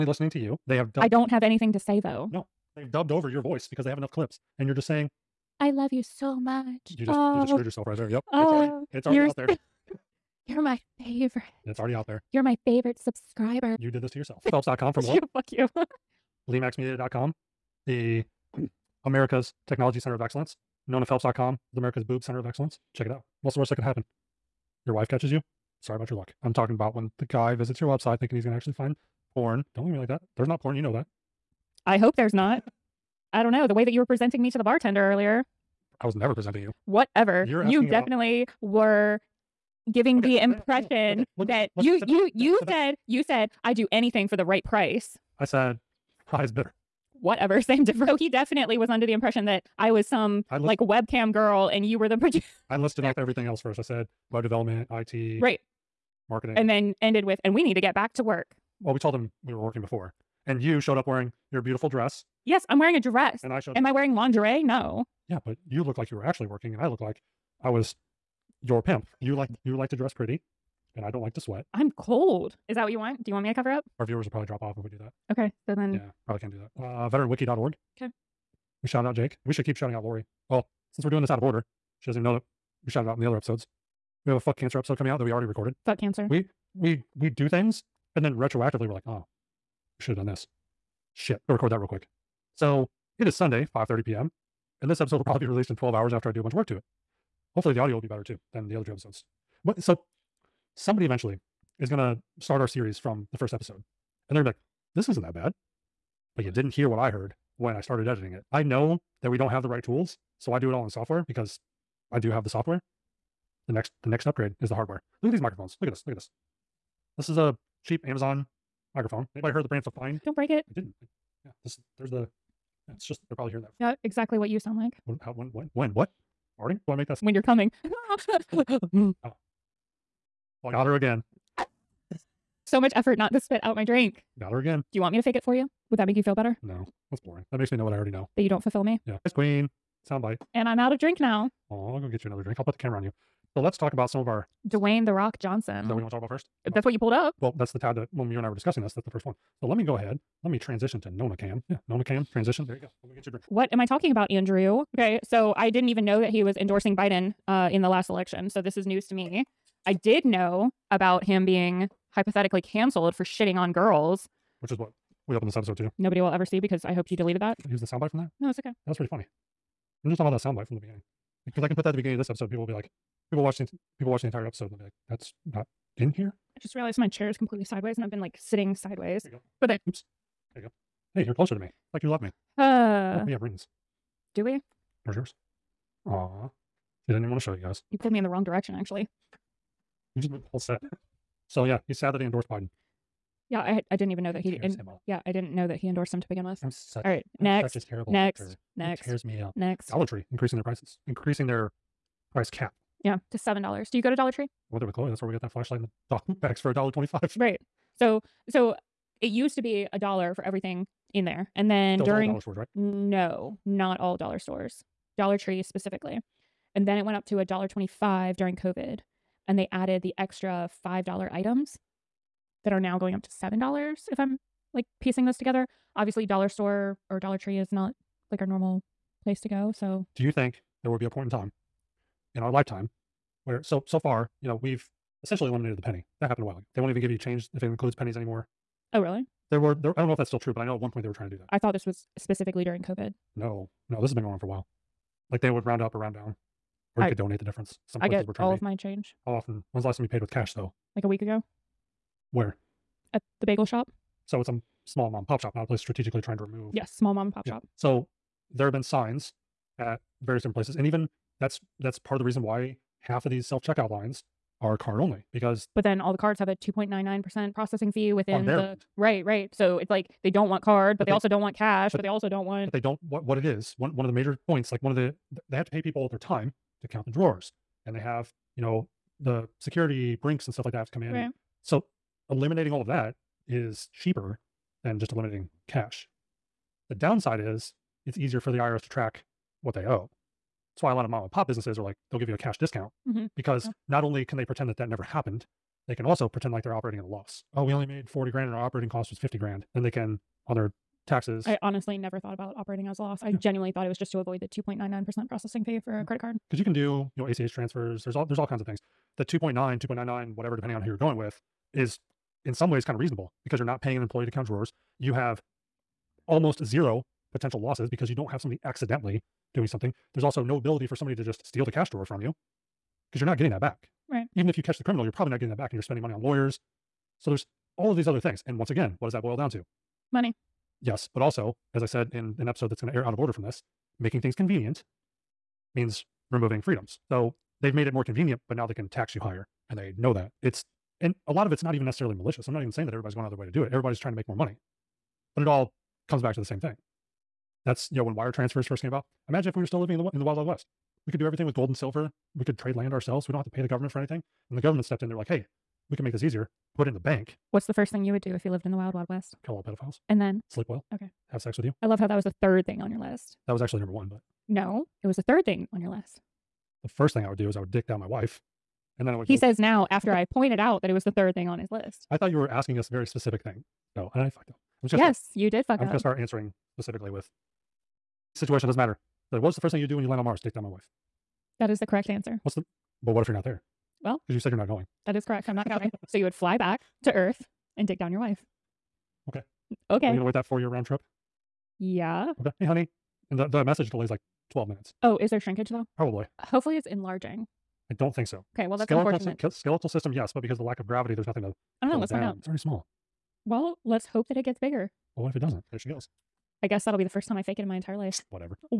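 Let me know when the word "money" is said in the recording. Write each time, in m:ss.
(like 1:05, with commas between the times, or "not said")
5:26, 5:30, 5:44.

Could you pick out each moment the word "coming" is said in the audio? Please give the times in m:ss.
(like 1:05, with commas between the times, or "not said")
1:24, 2:07.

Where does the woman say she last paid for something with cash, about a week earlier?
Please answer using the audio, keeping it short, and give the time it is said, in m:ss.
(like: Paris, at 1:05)
The bagel shop, at 4:13.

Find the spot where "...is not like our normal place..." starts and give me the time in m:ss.
3:47.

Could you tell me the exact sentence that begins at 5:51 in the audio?
We could do everything with gold and silver we could trade land ourselves.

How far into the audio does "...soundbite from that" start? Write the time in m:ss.
2:47.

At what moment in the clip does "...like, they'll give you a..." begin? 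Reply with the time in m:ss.
4:51.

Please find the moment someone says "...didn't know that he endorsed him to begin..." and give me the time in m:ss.
3:15.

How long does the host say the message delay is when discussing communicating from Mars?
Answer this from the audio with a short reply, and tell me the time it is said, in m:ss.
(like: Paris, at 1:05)
12 minutes, at 6:34.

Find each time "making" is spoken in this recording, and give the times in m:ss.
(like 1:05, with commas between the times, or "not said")
5:34.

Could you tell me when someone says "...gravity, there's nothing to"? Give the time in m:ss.
6:40.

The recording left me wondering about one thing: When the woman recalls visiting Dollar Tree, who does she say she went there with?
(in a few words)
Chloe.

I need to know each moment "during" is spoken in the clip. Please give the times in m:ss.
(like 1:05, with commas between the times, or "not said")
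3:32, 3:38, 4:02.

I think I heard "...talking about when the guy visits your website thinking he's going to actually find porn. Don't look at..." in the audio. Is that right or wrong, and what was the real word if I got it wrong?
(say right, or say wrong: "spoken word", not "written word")
right.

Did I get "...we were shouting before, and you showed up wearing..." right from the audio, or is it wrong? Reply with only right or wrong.
wrong.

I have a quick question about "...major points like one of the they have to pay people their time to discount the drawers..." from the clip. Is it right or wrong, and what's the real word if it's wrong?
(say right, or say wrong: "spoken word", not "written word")
wrong: "count", not "discount".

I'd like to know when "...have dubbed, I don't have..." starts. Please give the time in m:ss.
0:00.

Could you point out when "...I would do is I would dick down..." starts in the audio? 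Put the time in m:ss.
6:07.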